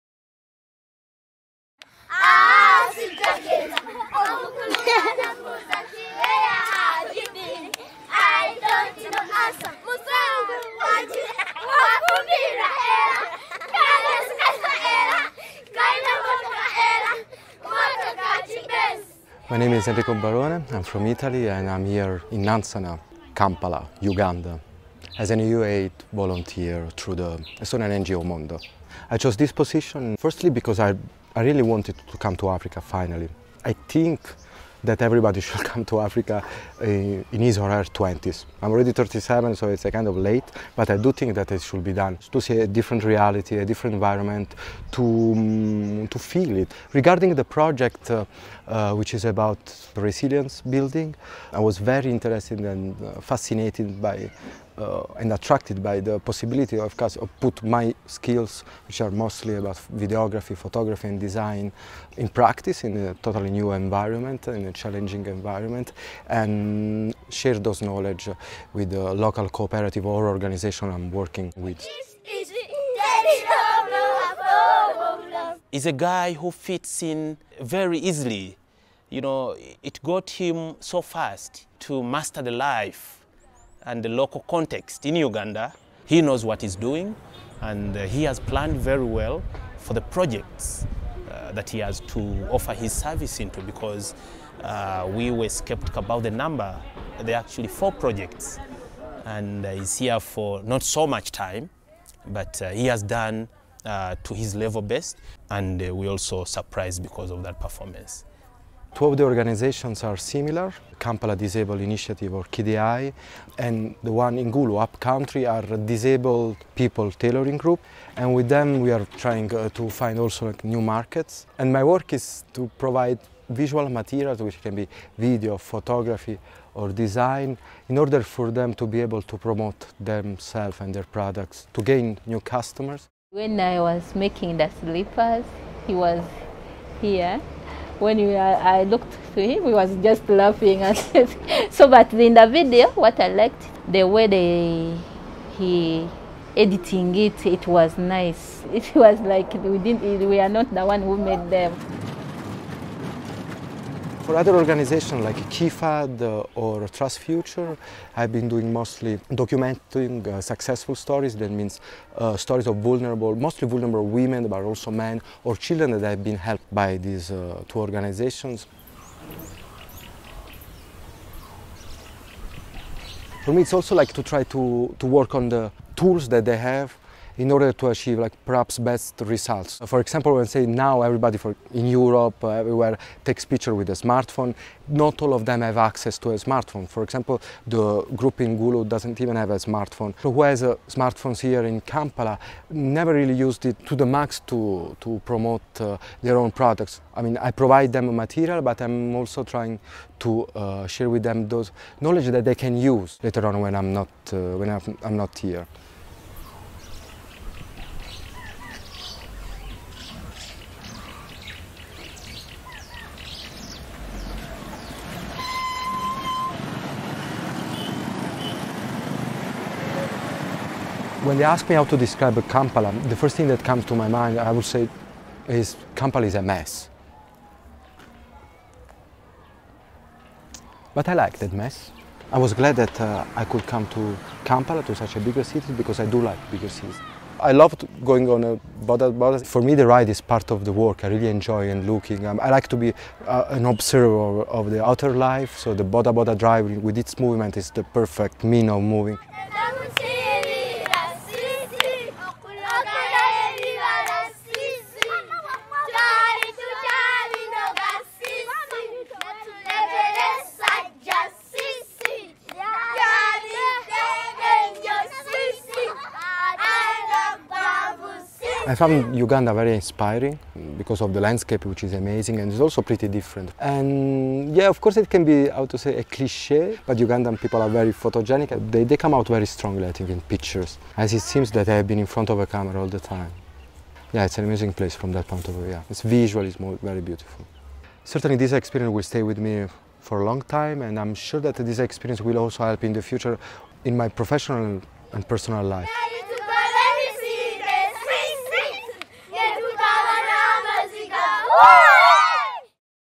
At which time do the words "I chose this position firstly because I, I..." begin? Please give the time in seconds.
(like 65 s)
29 s.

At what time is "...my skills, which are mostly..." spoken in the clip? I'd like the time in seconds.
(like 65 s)
57 s.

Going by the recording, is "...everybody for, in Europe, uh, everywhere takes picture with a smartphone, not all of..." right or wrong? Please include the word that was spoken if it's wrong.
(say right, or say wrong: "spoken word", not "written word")
right.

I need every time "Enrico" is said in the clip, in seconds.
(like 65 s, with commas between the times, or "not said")
19 s.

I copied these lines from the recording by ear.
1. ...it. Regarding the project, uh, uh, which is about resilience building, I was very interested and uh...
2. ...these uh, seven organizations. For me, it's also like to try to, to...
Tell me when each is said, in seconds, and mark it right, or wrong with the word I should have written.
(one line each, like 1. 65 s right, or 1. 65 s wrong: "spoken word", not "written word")
1. 46 s right
2. 166 s wrong: "two", not "seven".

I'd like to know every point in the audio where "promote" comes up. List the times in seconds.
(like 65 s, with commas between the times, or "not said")
129 s, 195 s.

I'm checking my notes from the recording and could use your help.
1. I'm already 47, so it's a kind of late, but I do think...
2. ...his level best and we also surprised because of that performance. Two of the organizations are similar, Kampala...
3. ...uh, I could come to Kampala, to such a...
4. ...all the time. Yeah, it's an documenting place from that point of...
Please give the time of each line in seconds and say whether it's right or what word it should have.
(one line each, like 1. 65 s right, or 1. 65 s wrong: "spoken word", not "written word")
1. 38 s wrong: "37", not "47"
2. 104 s right
3. 232 s right
4. 282 s wrong: "amazing", not "documenting".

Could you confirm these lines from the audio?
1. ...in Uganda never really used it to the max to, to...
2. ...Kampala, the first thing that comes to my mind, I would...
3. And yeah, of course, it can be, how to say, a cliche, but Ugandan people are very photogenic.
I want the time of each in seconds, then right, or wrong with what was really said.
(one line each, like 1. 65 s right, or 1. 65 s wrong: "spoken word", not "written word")
1. 191 s wrong: "Kampala", not "Uganda"
2. 222 s right
3. 273 s right.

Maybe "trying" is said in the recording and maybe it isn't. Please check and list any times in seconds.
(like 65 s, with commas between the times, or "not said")
119 s, 199 s.